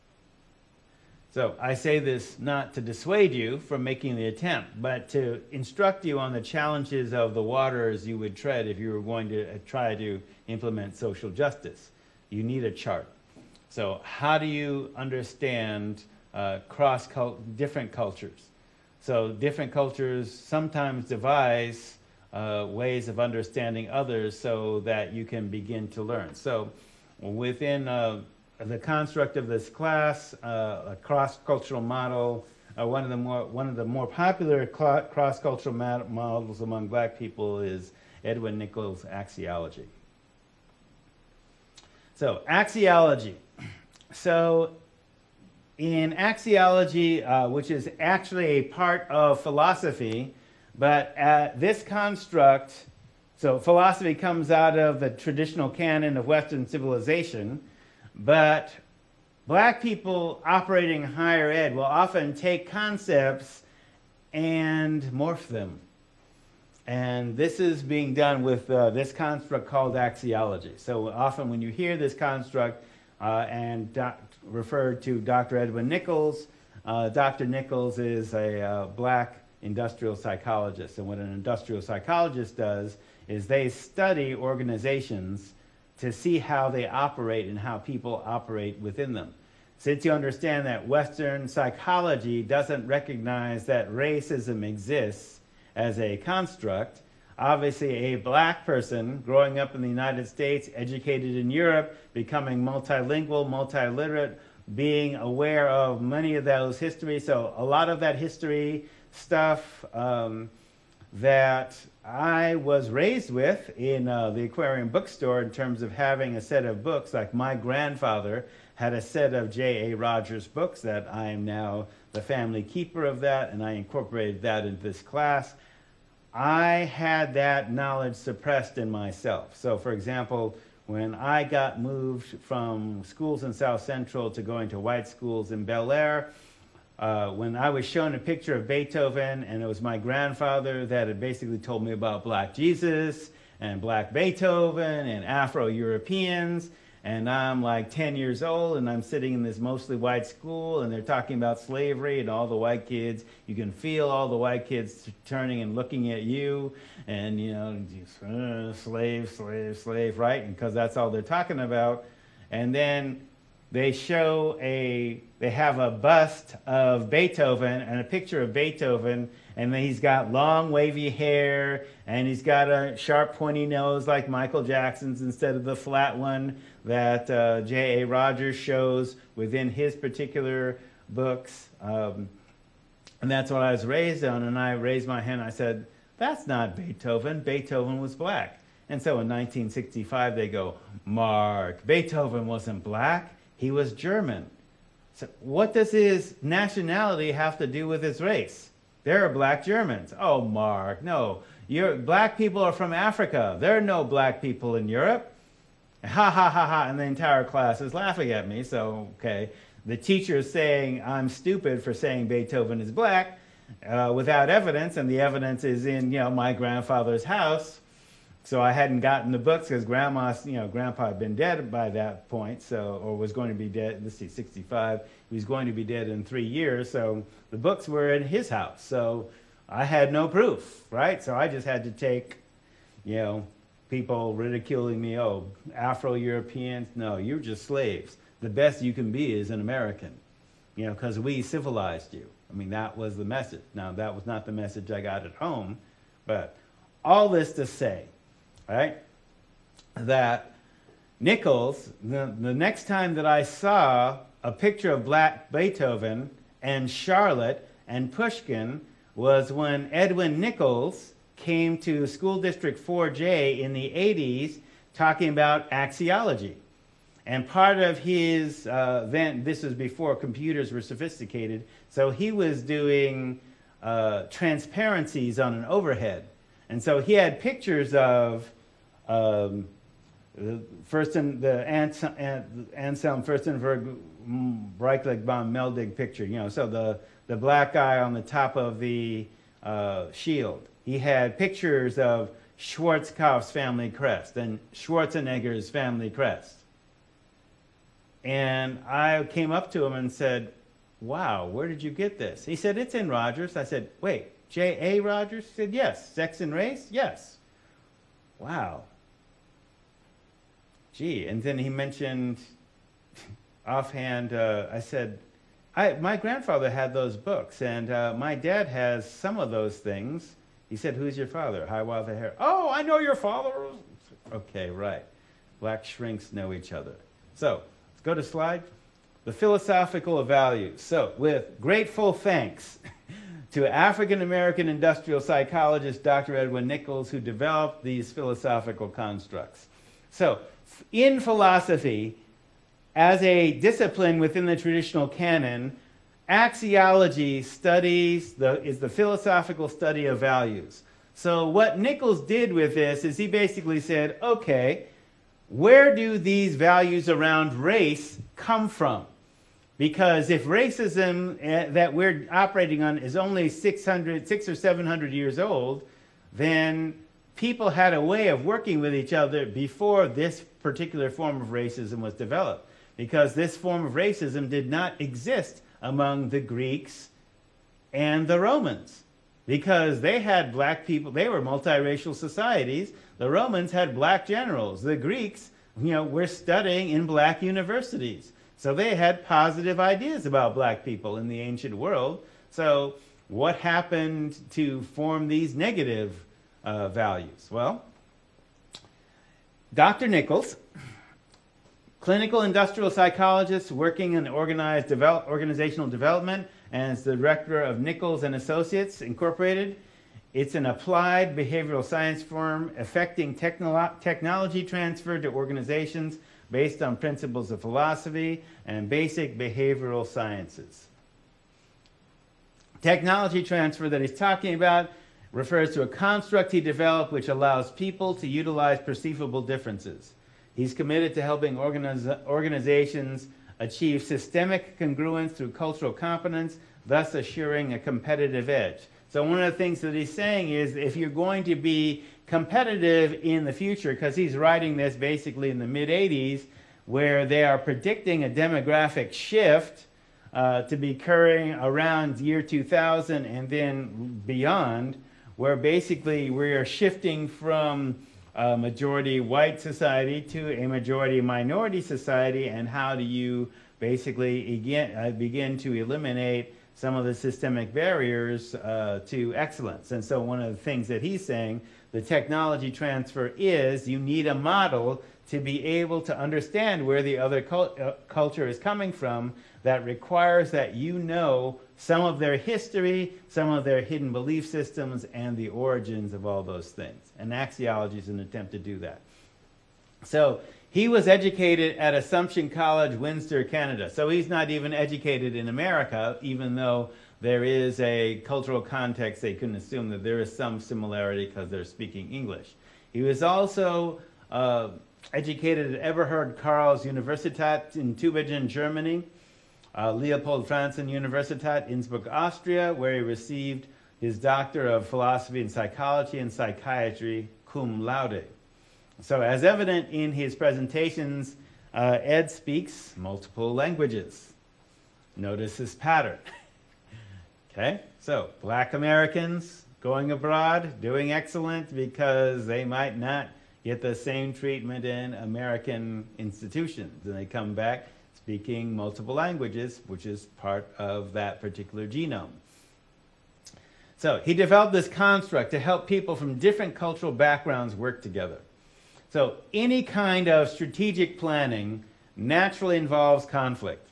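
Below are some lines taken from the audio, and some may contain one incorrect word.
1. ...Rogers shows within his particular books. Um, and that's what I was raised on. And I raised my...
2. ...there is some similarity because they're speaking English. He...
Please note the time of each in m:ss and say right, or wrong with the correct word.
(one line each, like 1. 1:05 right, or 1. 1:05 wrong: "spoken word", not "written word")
1. 2:58 right
2. 8:20 right.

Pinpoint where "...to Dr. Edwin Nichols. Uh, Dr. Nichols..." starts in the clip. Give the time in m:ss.
1:15.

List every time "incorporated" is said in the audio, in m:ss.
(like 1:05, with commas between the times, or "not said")
2:03, 6:49.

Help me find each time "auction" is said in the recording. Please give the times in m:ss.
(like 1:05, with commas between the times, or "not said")
not said.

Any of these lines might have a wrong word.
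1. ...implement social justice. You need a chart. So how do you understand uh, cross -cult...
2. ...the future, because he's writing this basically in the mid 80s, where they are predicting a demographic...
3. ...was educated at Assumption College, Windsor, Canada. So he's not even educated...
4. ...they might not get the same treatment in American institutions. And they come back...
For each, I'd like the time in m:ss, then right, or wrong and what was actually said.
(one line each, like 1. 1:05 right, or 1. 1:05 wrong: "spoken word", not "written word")
1. 0:10 right
2. 7:23 right
3. 8:10 right
4. 8:52 right.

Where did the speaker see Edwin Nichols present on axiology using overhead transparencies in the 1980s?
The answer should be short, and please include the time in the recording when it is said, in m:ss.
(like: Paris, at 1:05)
School District 4J, at 4:22.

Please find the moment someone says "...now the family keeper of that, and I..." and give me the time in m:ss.
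2:01.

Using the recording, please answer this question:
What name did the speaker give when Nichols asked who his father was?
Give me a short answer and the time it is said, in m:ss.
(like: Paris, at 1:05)
Hiawatha Hare, at 5:21.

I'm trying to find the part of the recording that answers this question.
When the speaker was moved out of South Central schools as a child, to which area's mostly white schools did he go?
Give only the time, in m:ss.
2:15.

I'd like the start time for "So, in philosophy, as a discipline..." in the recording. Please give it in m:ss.
5:40.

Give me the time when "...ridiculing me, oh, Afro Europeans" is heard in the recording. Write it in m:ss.
3:54.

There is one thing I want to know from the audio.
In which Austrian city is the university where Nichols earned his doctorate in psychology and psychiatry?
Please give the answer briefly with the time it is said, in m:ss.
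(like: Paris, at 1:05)
Innsbruck, at 8:31.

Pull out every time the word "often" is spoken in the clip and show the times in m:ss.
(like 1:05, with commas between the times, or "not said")
1:01, 1:11.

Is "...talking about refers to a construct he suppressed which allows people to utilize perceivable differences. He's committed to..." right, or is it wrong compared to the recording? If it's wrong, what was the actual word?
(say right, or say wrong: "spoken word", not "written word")
wrong: "developed", not "suppressed".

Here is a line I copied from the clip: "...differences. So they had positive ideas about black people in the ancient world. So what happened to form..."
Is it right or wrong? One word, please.
wrong.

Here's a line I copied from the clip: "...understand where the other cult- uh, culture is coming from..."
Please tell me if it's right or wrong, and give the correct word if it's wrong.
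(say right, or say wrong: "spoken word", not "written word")
right.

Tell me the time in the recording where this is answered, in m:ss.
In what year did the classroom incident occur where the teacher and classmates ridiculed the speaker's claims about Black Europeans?
3:09.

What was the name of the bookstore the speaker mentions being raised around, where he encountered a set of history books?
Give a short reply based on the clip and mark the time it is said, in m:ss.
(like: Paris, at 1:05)
Aquarian bookstore, at 1:54.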